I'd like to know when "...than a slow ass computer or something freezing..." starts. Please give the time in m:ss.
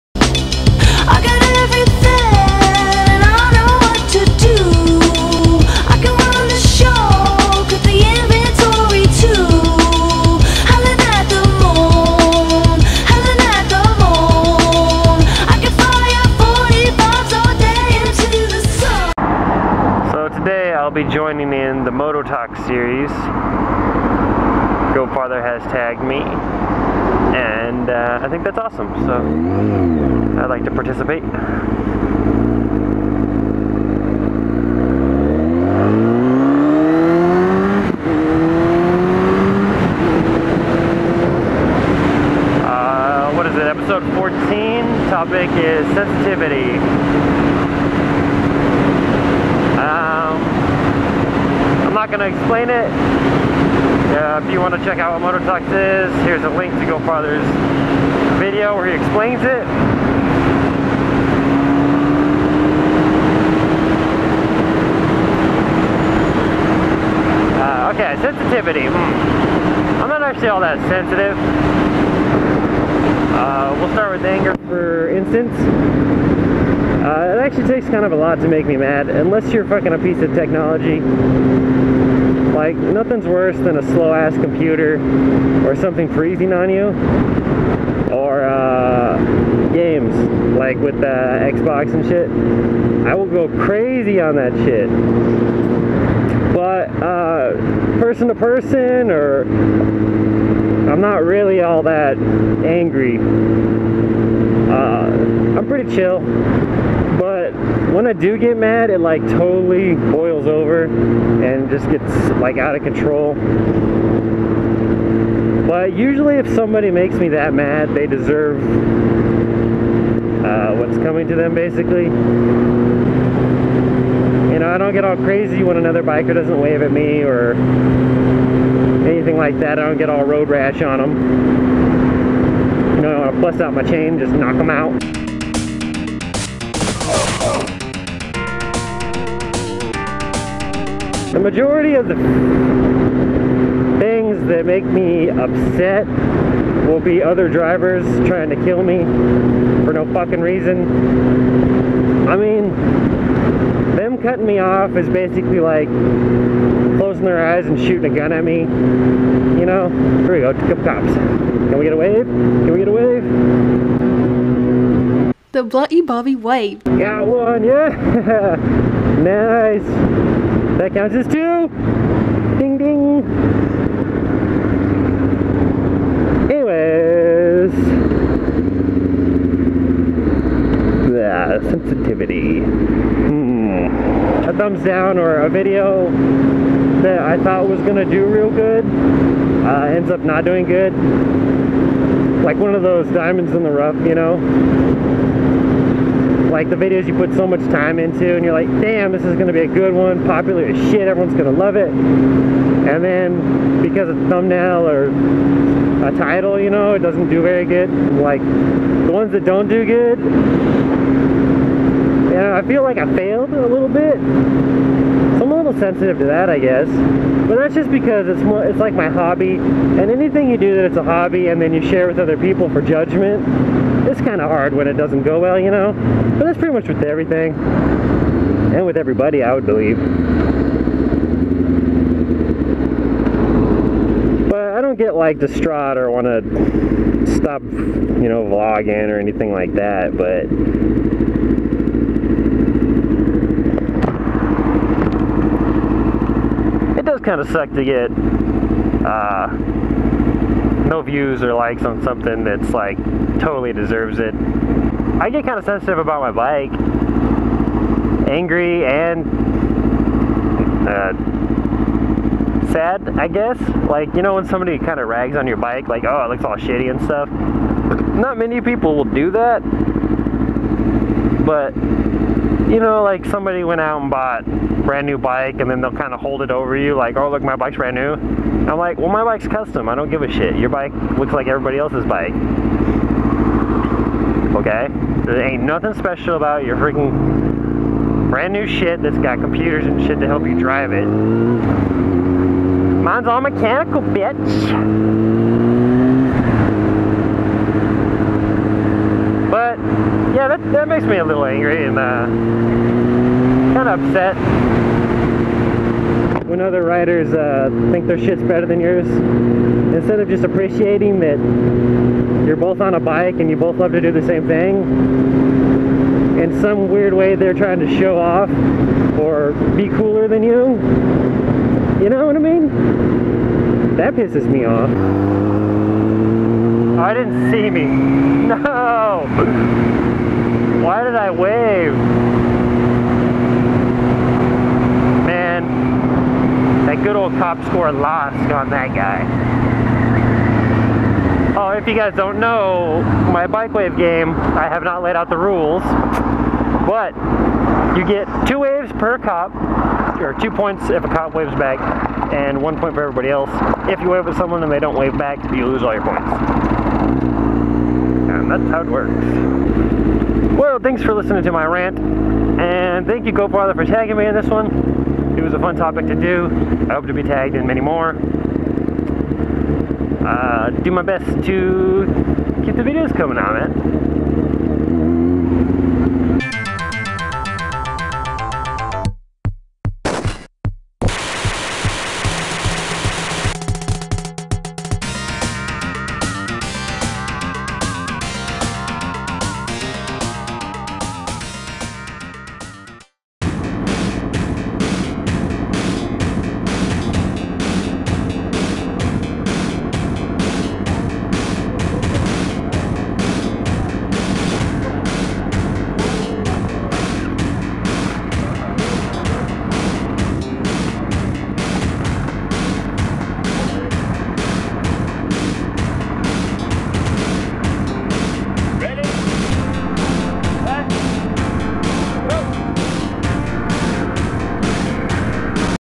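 1:23.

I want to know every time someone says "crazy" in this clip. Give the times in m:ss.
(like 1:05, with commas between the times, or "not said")
1:33, 2:05.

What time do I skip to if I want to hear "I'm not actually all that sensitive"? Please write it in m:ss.
1:10.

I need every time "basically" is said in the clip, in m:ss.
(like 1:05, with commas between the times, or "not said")
2:01, 2:35.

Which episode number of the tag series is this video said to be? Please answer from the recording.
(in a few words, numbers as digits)
14.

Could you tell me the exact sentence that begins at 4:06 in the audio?
It does kind of suck to get, uh, no views or likes on something that's like totally deserves it.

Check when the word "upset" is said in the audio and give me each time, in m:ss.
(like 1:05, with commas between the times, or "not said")
2:25, 5:04.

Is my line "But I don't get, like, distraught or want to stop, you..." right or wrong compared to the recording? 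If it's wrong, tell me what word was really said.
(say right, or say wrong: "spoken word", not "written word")
right.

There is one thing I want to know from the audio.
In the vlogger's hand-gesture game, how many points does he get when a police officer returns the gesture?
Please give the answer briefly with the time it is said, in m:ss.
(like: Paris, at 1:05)
2, at 5:50.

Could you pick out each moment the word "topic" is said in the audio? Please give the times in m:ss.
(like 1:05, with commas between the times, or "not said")
0:45, 6:05.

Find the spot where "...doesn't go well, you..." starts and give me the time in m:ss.
3:44.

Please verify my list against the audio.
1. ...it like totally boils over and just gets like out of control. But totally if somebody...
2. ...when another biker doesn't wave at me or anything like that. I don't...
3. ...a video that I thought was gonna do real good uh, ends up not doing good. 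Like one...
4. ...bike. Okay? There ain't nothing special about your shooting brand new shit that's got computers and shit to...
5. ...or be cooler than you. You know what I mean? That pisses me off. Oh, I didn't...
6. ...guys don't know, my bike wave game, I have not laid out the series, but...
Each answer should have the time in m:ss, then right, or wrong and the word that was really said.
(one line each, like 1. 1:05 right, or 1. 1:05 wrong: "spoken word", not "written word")
1. 1:48 wrong: "usually", not "totally"
2. 2:05 right
3. 3:05 right
4. 4:42 wrong: "freaking", not "shooting"
5. 5:19 right
6. 5:41 wrong: "rules", not "series".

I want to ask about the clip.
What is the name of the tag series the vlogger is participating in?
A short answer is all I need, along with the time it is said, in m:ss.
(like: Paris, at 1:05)
Mototalks, at 0:55.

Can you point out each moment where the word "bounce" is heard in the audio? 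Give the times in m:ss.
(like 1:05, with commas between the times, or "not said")
not said.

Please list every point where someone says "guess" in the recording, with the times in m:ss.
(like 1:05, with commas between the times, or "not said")
3:36, 4:23.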